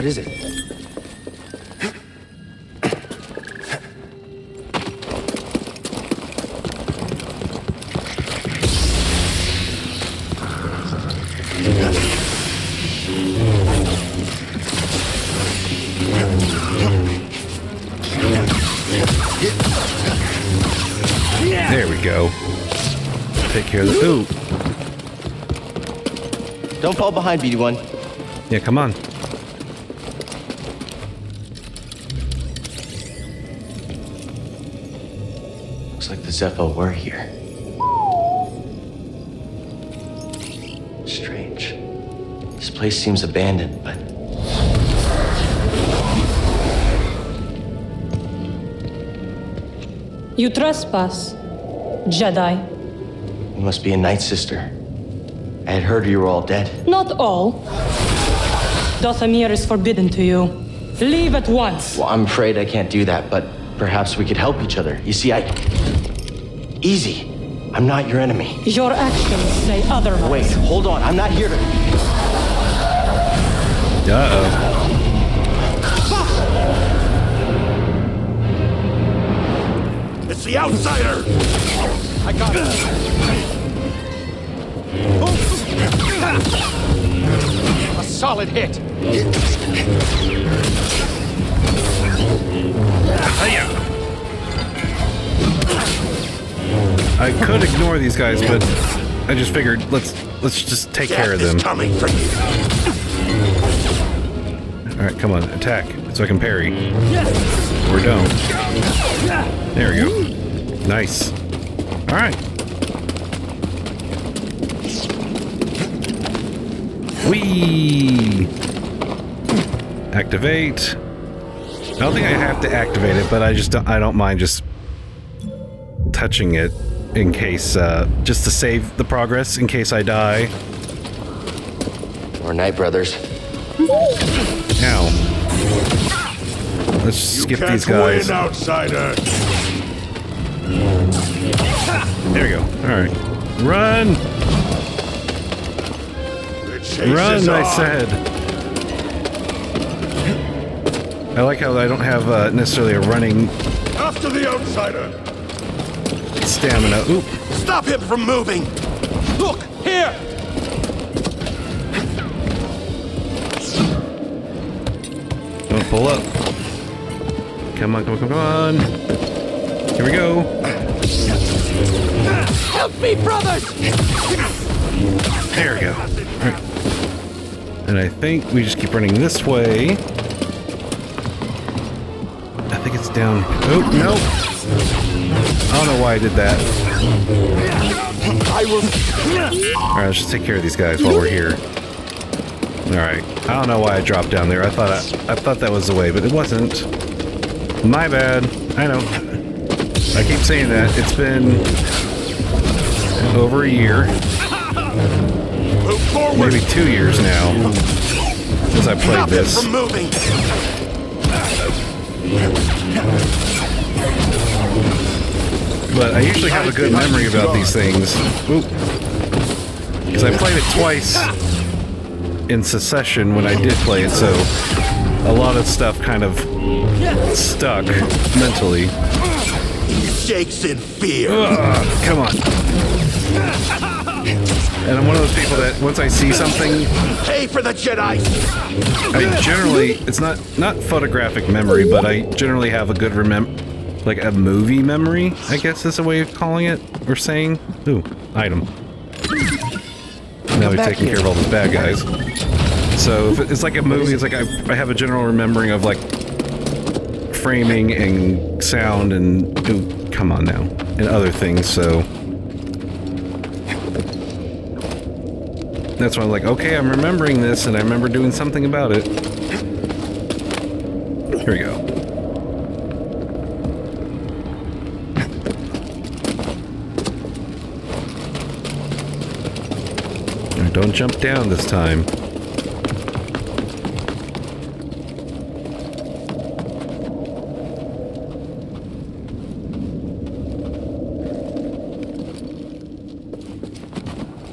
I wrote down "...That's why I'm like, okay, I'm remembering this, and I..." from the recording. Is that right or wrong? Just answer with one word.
right.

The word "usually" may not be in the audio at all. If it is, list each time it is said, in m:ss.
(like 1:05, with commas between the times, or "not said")
3:36.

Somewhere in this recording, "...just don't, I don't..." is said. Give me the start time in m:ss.
2:03.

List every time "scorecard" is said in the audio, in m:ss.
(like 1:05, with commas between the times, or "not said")
not said.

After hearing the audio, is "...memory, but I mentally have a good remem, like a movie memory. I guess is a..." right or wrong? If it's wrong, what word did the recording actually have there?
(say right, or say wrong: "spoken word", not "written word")
wrong: "generally", not "mentally".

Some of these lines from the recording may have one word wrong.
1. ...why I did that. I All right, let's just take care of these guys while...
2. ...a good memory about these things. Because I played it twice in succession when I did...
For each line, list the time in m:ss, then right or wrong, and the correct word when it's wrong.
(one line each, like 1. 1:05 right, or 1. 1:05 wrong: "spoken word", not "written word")
1. 3:06 right
2. 3:36 right.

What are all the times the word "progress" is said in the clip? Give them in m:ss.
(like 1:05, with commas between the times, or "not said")
2:09.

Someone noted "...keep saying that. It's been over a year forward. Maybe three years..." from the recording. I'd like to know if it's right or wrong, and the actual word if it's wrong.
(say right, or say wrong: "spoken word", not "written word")
wrong: "two", not "three".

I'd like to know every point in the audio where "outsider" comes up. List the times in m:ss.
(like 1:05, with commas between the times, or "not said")
1:20, 2:18, 2:34.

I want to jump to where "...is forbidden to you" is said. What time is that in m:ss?
0:59.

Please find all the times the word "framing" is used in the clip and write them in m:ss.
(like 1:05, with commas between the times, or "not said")
4:17.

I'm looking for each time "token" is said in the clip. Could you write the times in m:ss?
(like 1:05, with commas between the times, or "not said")
not said.